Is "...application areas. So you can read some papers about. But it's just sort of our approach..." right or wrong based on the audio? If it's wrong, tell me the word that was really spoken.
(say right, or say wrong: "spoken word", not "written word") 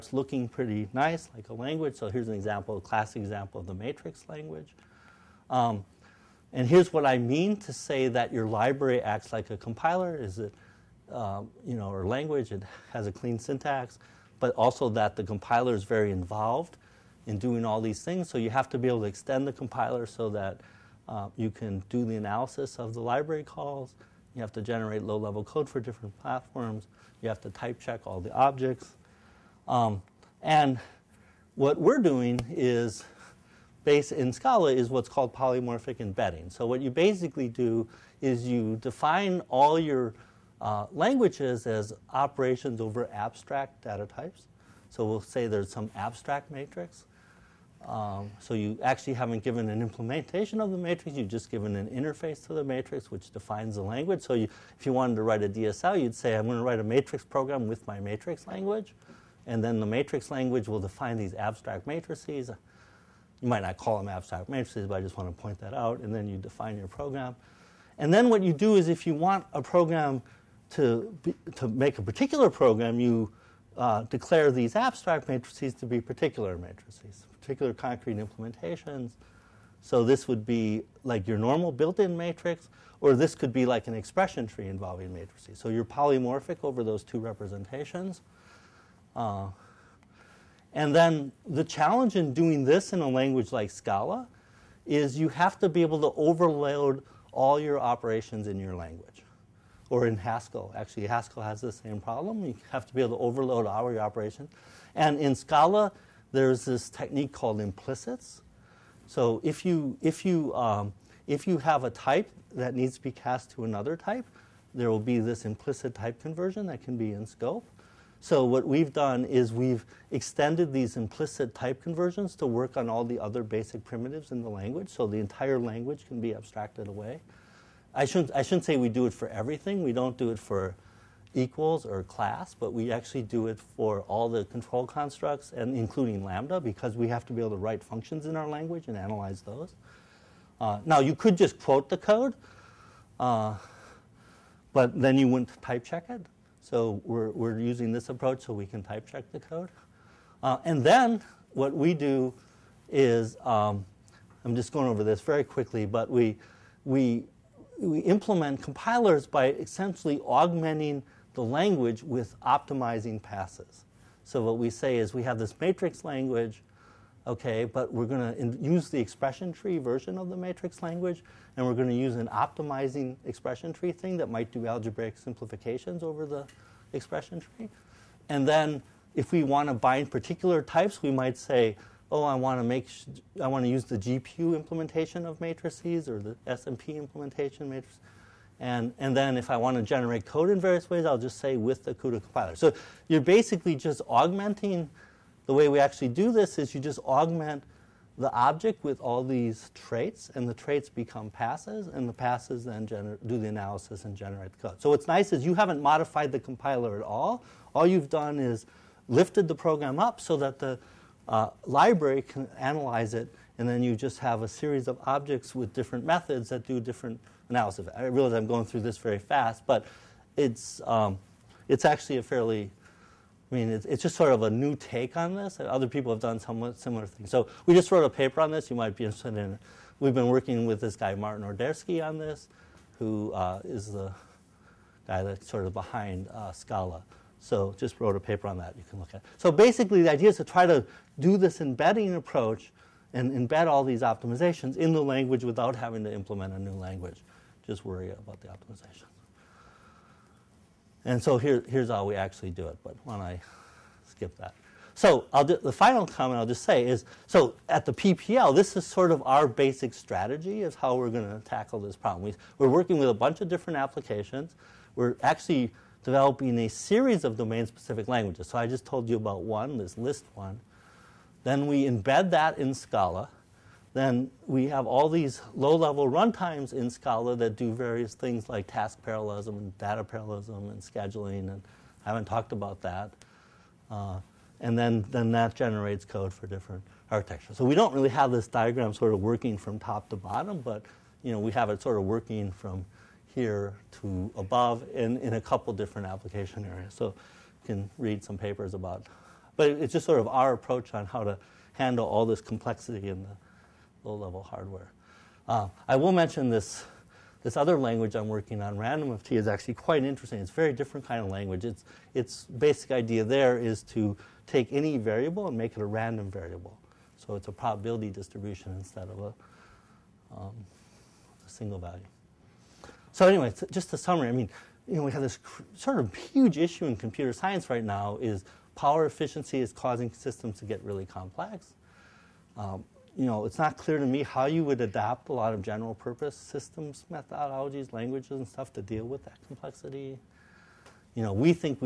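right.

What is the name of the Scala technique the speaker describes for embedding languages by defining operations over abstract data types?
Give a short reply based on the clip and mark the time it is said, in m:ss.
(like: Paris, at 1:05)
Polymorphic embedding, at 0:35.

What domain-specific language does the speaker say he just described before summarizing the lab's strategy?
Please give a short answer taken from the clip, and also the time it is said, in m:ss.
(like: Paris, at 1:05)
Liszt, at 4:29.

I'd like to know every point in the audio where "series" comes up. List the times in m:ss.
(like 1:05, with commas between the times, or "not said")
3:34, 4:26.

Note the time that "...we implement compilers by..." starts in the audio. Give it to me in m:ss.
2:37.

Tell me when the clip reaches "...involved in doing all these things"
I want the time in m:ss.
0:16.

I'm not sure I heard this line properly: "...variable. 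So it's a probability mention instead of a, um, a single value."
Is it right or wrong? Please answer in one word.
wrong.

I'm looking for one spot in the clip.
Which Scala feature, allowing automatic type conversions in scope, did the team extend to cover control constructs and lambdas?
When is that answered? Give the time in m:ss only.
1:47.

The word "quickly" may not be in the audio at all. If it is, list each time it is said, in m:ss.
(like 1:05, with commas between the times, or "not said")
2:35.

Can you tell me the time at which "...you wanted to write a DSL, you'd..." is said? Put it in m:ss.
0:54.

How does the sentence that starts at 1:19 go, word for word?
So this would be like your normal built-in matrix, or this could be like an expression tree involving matrices.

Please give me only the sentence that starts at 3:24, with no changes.
So what's nice is you haven't modified the compiler at all.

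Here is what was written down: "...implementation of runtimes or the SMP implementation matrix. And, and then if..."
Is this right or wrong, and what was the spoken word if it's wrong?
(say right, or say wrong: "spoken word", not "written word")
wrong: "matrices", not "runtimes".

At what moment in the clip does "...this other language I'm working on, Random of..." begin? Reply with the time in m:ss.
5:07.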